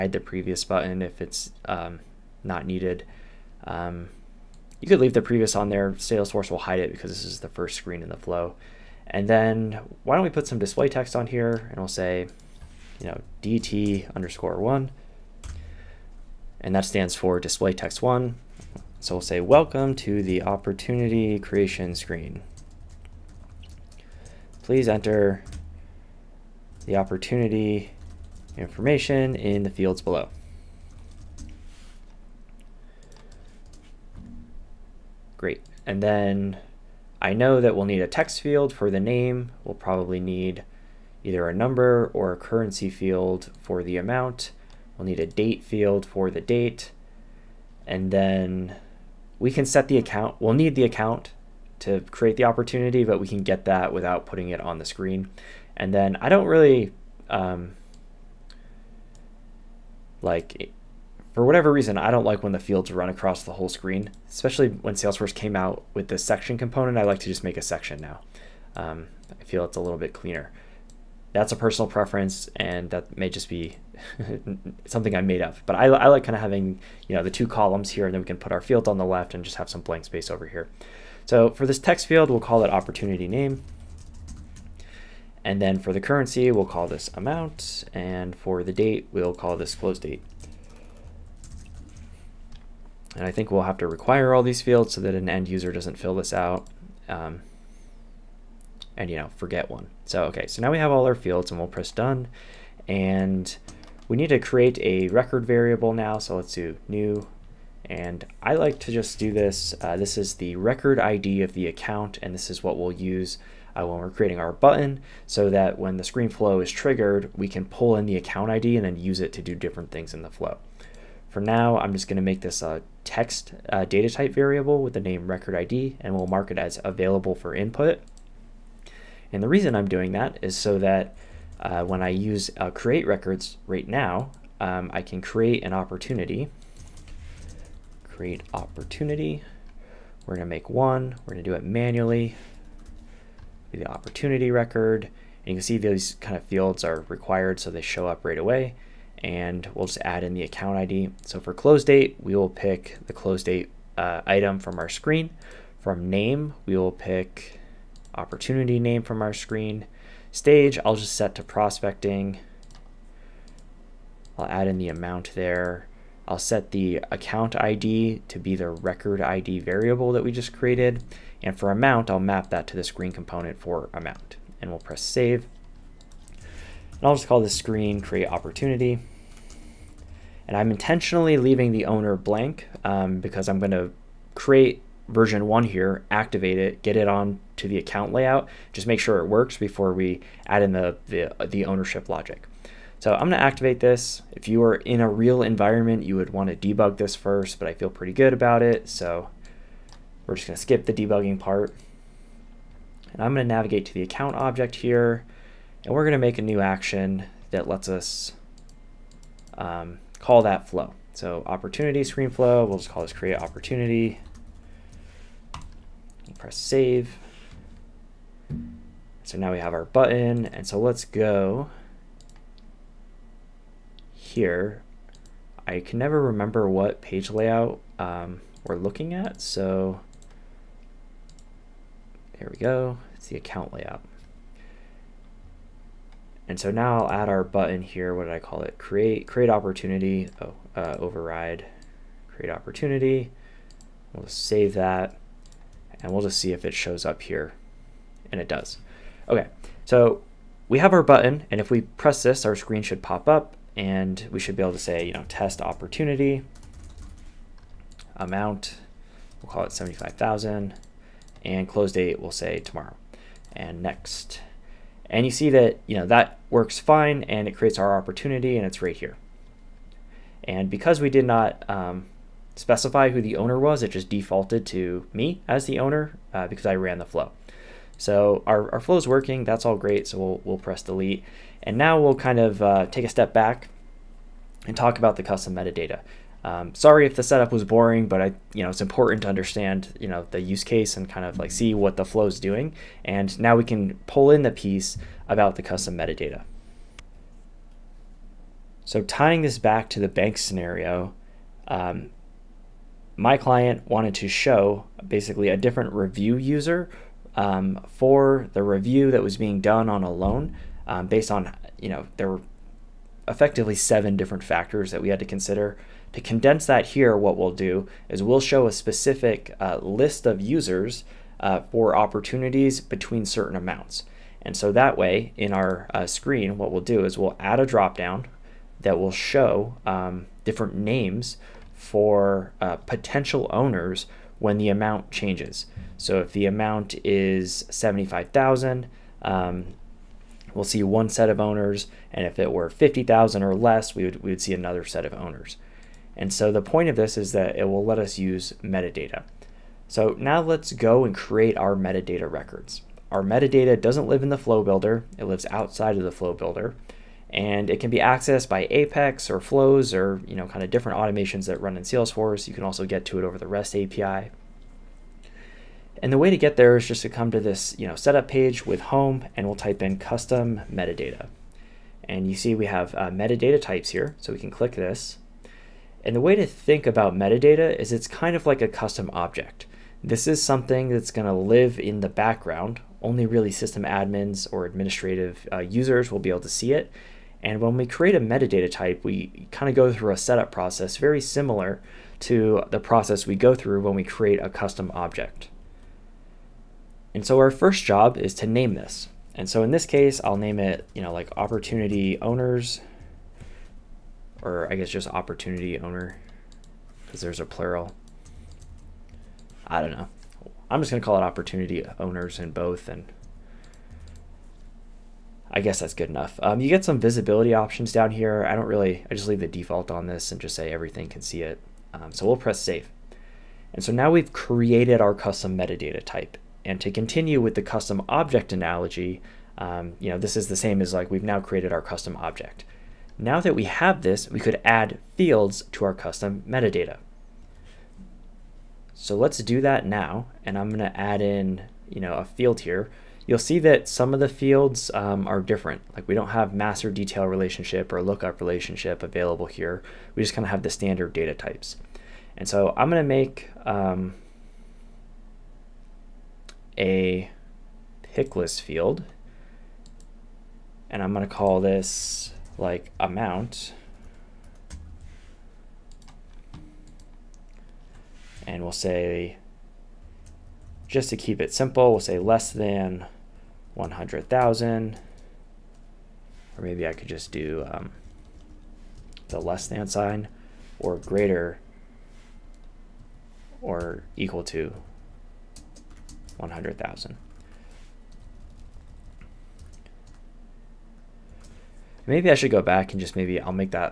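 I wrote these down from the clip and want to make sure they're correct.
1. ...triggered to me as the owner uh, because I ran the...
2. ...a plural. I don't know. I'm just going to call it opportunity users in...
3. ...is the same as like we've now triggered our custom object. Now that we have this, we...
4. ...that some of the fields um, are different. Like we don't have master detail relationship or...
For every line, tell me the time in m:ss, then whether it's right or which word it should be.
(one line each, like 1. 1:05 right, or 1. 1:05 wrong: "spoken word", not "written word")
1. 4:34 wrong: "defaulted", not "triggered"
2. 6:47 wrong: "owners", not "users"
3. 7:10 wrong: "created", not "triggered"
4. 7:23 right.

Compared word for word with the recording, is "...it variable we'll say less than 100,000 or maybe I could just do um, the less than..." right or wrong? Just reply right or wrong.
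wrong.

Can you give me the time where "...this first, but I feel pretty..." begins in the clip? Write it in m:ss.
3:16.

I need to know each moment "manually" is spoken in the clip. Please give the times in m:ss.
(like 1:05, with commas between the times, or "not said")
2:21.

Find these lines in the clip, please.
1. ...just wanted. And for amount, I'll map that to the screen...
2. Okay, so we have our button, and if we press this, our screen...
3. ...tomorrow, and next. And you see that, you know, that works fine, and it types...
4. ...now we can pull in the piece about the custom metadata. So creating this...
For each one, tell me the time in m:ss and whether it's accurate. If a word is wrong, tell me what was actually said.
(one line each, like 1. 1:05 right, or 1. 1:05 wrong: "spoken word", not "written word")
1. 2:50 wrong: "created", not "wanted"
2. 4:09 right
3. 4:22 wrong: "creates", not "types"
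4. 4:53 wrong: "tying", not "creating".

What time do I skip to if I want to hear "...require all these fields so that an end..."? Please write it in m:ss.
1:33.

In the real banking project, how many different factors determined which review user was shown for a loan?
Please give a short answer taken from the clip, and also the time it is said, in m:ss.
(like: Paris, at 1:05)
7, at 5:13.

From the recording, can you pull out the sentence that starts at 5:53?
Our metadata doesn't live in the flow builder.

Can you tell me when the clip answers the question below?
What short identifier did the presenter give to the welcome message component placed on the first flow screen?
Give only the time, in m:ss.
0:13.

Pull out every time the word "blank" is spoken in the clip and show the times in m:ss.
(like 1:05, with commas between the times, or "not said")
1:19, 3:02.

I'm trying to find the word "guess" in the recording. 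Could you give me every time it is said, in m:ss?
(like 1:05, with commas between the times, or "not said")
6:44, 6:55.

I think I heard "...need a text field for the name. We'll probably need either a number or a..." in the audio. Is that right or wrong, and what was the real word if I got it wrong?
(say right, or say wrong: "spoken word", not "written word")
right.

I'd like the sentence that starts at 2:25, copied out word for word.
And you can see these kind of fields are required so they show up right away.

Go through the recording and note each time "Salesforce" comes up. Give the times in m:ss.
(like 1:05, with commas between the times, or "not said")
0:05, 1:04, 6:01.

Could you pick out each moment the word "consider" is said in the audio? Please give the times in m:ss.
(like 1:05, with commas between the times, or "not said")
5:15.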